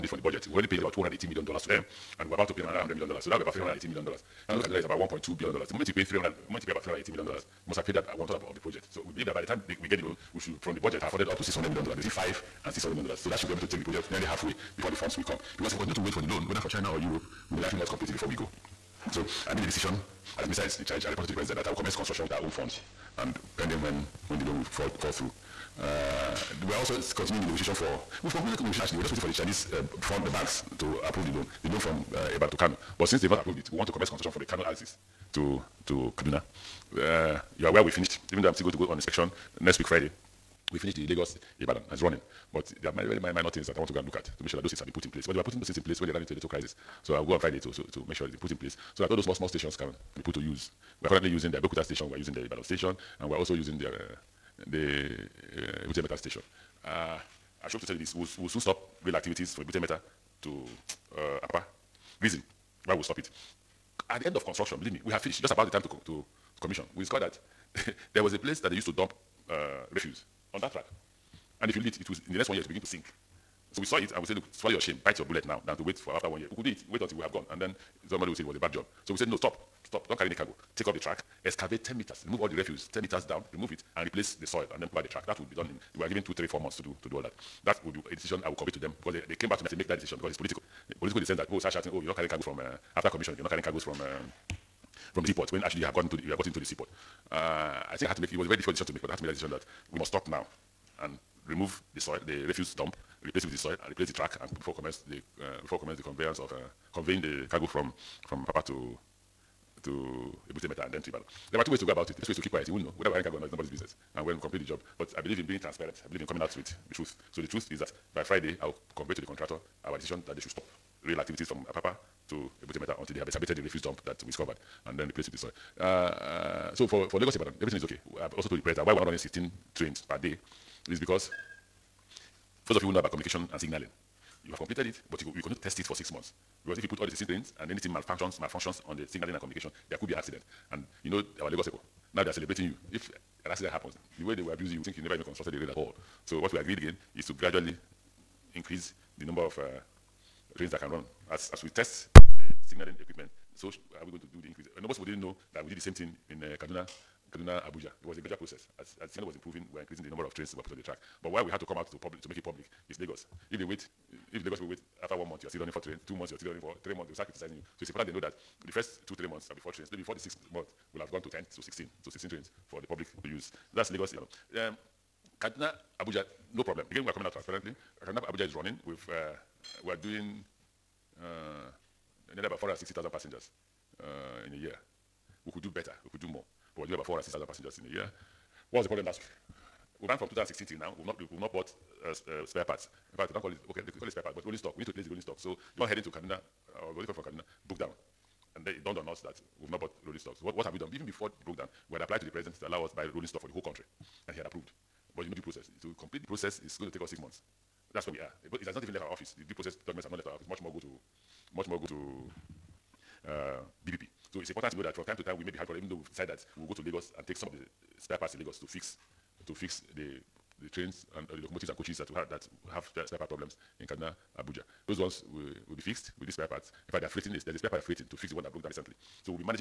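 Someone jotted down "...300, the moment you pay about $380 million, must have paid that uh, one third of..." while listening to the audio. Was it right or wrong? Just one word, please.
right.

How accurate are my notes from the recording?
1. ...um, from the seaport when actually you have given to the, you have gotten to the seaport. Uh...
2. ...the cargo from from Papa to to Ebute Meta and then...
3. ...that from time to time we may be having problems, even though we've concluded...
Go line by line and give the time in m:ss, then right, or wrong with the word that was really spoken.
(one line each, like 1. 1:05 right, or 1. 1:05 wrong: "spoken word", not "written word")
1. 1:33 wrong: "gotten", not "given"
2. 1:47 right
3. 3:34 wrong: "decided", not "concluded".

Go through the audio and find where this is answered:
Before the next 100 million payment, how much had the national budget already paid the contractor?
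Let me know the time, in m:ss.
0:00.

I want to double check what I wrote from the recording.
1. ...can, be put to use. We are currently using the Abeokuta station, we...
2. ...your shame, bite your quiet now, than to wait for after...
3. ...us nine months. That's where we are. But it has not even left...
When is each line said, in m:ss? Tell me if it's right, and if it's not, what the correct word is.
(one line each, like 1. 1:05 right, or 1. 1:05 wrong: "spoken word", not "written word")
1. 0:49 right
2. 1:14 wrong: "bullet", not "quiet"
3. 3:27 wrong: "six", not "nine".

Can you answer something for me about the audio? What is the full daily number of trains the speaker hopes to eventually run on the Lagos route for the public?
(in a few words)
16.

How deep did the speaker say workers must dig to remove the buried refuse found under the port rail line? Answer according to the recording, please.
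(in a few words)
10 meters.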